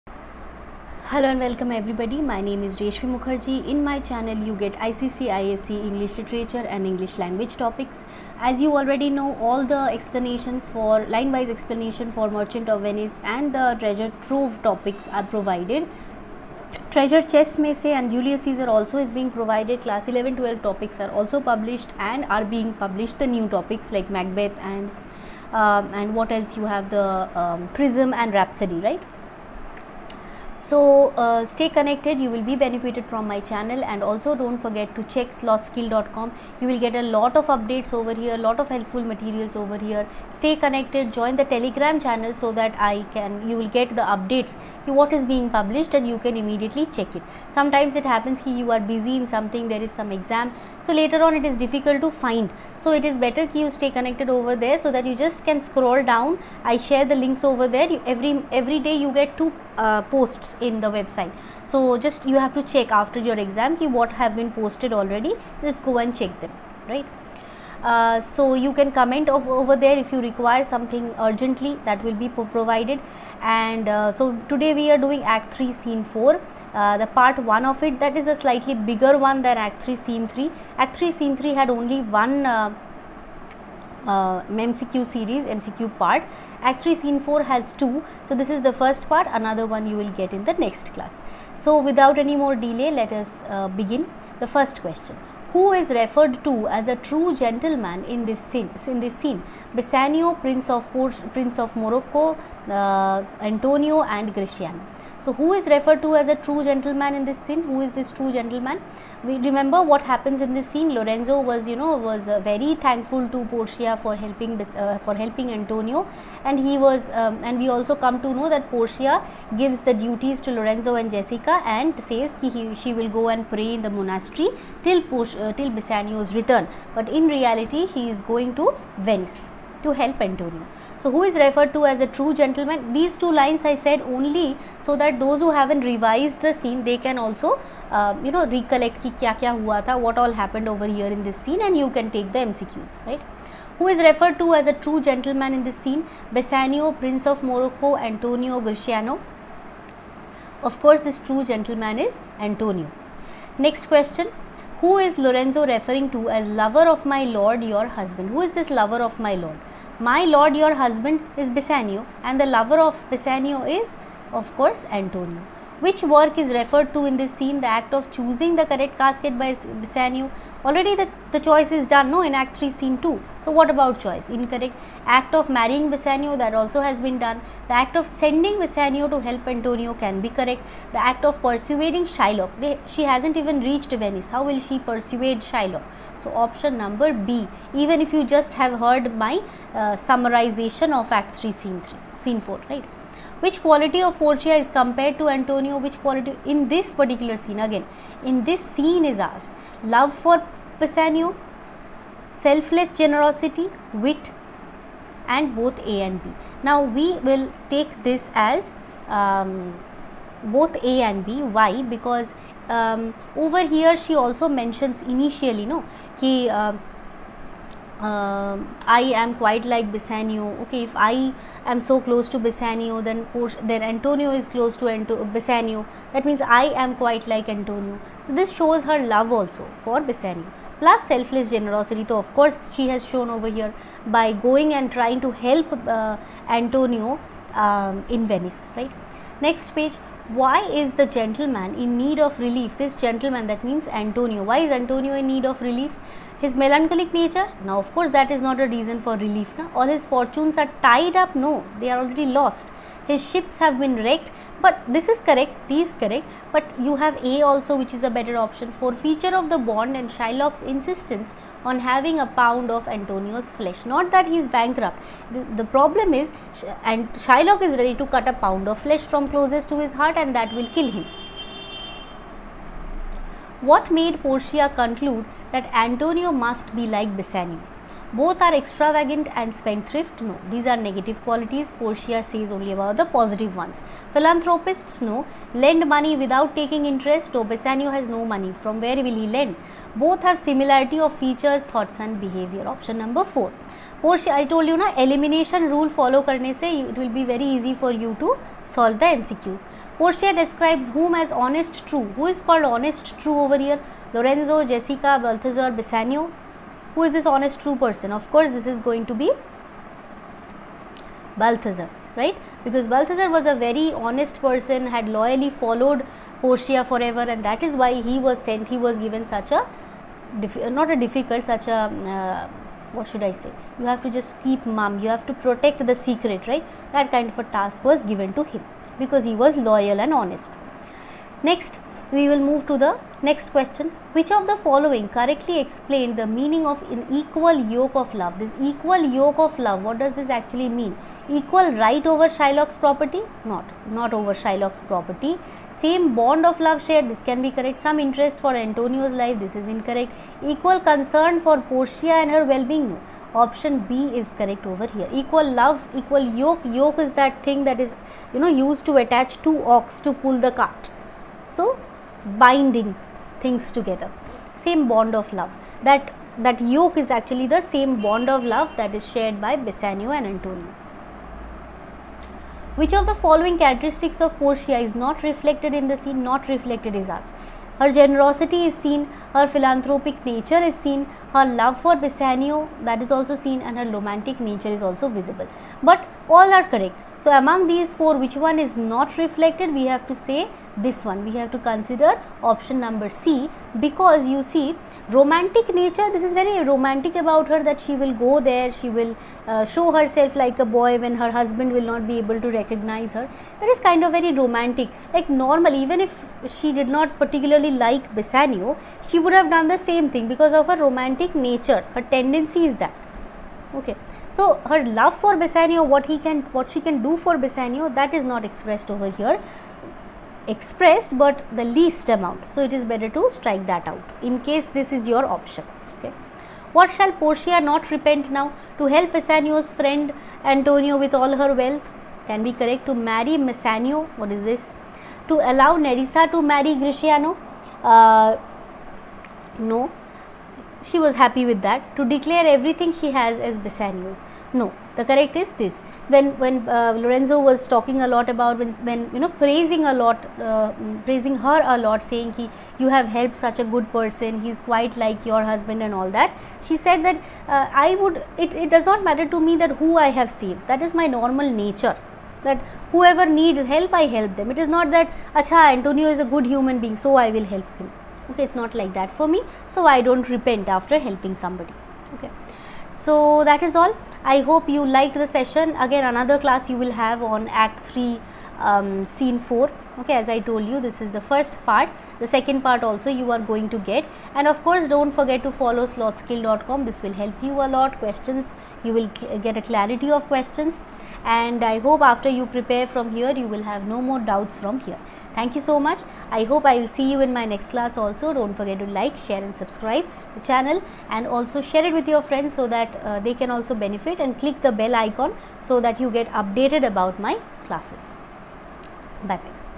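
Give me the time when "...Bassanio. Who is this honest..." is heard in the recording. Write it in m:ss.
5:05.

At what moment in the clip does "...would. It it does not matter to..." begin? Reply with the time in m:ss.
7:38.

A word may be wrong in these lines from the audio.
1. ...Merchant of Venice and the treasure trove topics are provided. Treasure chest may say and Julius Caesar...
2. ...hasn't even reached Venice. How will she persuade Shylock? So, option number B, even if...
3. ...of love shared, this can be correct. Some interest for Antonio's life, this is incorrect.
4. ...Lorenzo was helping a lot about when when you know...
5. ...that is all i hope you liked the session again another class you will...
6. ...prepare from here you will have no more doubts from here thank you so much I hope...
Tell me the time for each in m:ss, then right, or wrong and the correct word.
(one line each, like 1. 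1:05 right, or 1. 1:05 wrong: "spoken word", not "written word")
1. 0:12 right
2. 3:03 right
3. 5:46 right
4. 7:26 wrong: "talking", not "helping"
5. 7:53 right
6. 8:12 right.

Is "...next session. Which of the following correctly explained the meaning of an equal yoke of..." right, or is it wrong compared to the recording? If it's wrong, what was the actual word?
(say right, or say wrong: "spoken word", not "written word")
wrong: "question", not "session".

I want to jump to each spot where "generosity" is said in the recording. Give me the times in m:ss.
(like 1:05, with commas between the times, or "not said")
3:22, 3:51, 6:17.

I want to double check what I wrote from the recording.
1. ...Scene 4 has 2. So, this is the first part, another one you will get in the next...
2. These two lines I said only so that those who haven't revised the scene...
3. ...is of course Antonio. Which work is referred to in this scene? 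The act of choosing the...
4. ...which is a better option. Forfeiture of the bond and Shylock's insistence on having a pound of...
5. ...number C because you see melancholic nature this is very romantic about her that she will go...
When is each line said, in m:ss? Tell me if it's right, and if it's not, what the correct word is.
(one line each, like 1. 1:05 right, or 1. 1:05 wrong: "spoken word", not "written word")
1. 1:26 right
2. 2:12 right
3. 2:43 right
4. 4:17 right
5. 6:32 wrong: "romantic", not "melancholic".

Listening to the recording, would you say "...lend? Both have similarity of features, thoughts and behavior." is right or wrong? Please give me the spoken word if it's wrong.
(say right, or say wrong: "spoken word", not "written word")
right.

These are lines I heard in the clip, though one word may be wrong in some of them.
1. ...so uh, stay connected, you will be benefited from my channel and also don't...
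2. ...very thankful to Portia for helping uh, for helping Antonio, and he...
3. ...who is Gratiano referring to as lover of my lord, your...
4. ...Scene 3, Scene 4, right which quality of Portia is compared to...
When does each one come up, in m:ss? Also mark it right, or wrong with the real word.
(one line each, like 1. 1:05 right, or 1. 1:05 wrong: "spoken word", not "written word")
1. 0:30 right
2. 1:52 right
3. 2:34 wrong: "Lorenzo", not "Gratiano"
4. 3:11 right.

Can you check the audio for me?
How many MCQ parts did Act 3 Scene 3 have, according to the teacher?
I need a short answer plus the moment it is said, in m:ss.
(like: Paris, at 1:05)
1, at 1:21.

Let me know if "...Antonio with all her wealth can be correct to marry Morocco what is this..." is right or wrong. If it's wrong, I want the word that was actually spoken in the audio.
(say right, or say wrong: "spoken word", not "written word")
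wrong: "Bassanio", not "Morocco".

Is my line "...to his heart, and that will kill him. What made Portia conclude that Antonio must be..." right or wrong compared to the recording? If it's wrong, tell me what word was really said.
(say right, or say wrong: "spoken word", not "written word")
right.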